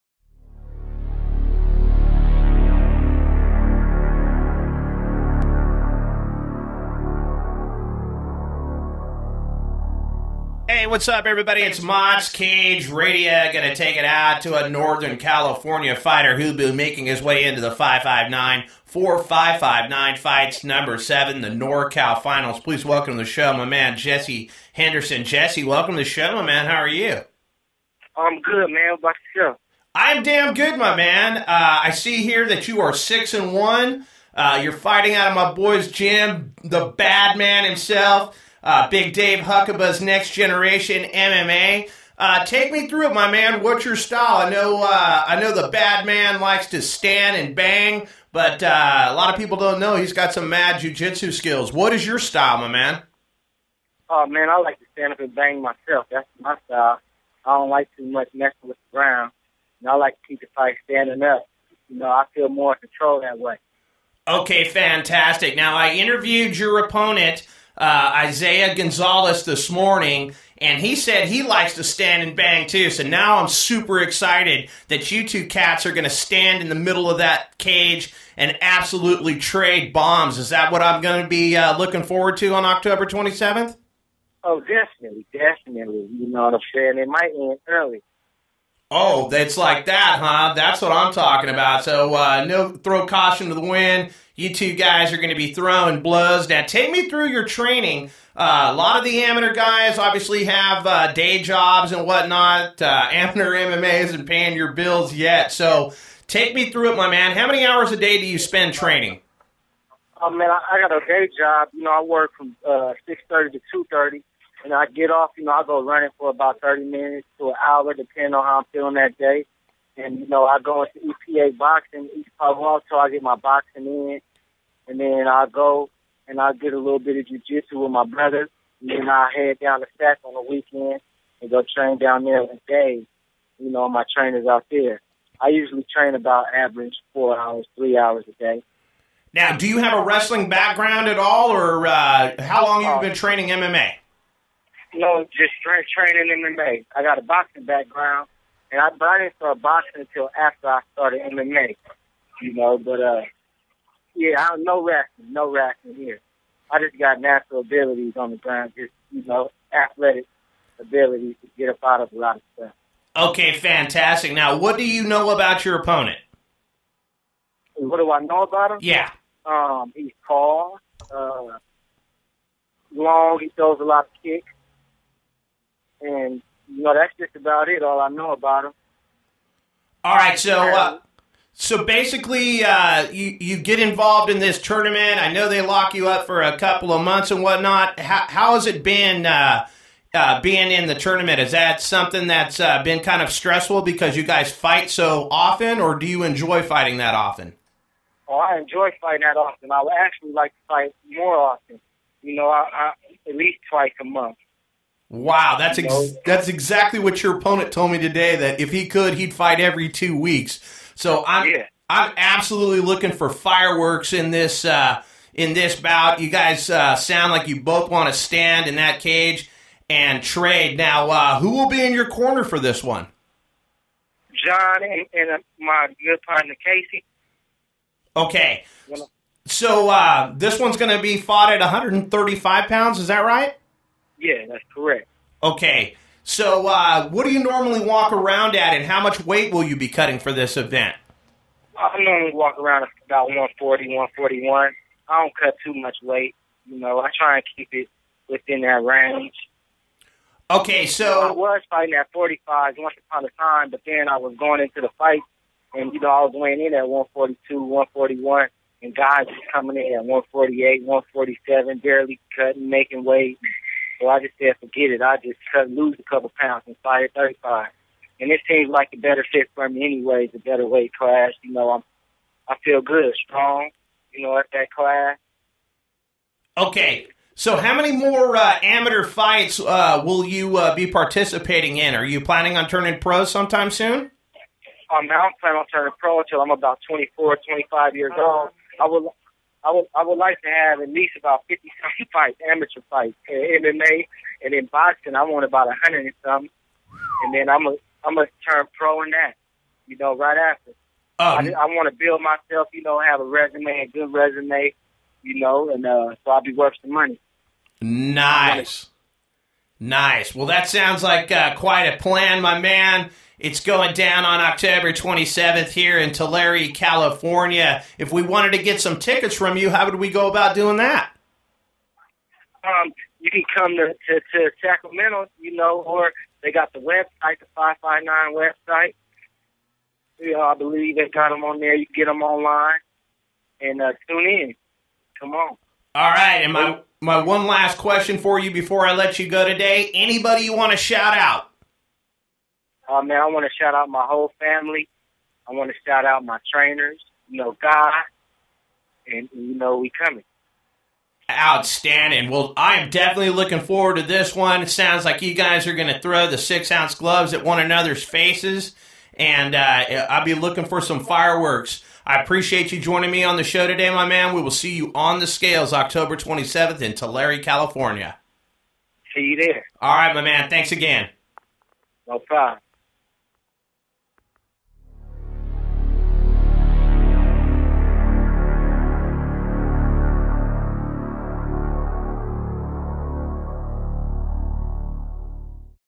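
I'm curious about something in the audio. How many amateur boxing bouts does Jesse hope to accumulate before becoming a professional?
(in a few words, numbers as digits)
a hundred and some.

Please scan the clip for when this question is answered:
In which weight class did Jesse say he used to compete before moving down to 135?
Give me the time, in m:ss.
4:12.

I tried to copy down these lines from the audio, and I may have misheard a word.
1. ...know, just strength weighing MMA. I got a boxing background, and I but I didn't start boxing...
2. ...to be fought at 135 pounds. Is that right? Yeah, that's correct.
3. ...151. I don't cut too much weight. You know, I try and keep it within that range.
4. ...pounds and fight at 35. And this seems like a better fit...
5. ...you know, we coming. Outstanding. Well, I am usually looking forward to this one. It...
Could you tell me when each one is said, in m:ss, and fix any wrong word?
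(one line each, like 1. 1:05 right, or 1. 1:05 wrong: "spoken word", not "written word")
1. 2:24 wrong: "training", not "weighing"
2. 3:50 right
3. 4:03 wrong: "141", not "151"
4. 4:26 right
5. 5:49 wrong: "definitely", not "usually".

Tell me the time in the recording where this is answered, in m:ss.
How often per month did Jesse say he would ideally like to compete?
3:23.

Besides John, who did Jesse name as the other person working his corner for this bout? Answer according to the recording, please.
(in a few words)
Casey.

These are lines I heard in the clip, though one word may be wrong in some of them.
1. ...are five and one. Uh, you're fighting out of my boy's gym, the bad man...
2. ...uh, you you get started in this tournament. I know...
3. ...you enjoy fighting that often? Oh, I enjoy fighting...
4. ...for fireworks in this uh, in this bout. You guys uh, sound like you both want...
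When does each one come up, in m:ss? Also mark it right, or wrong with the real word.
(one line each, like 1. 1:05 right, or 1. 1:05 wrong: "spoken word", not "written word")
1. 0:32 wrong: "six", not "five"
2. 3:02 wrong: "involved", not "started"
3. 3:16 right
4. 3:33 right.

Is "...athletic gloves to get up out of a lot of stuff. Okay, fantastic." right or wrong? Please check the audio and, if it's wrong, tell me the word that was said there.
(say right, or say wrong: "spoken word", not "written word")
wrong: "abilities", not "gloves".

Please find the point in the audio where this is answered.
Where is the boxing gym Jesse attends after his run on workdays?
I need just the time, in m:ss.
2:02.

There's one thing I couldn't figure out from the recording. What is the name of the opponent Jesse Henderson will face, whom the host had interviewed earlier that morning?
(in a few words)
Isaiah Gonzalez.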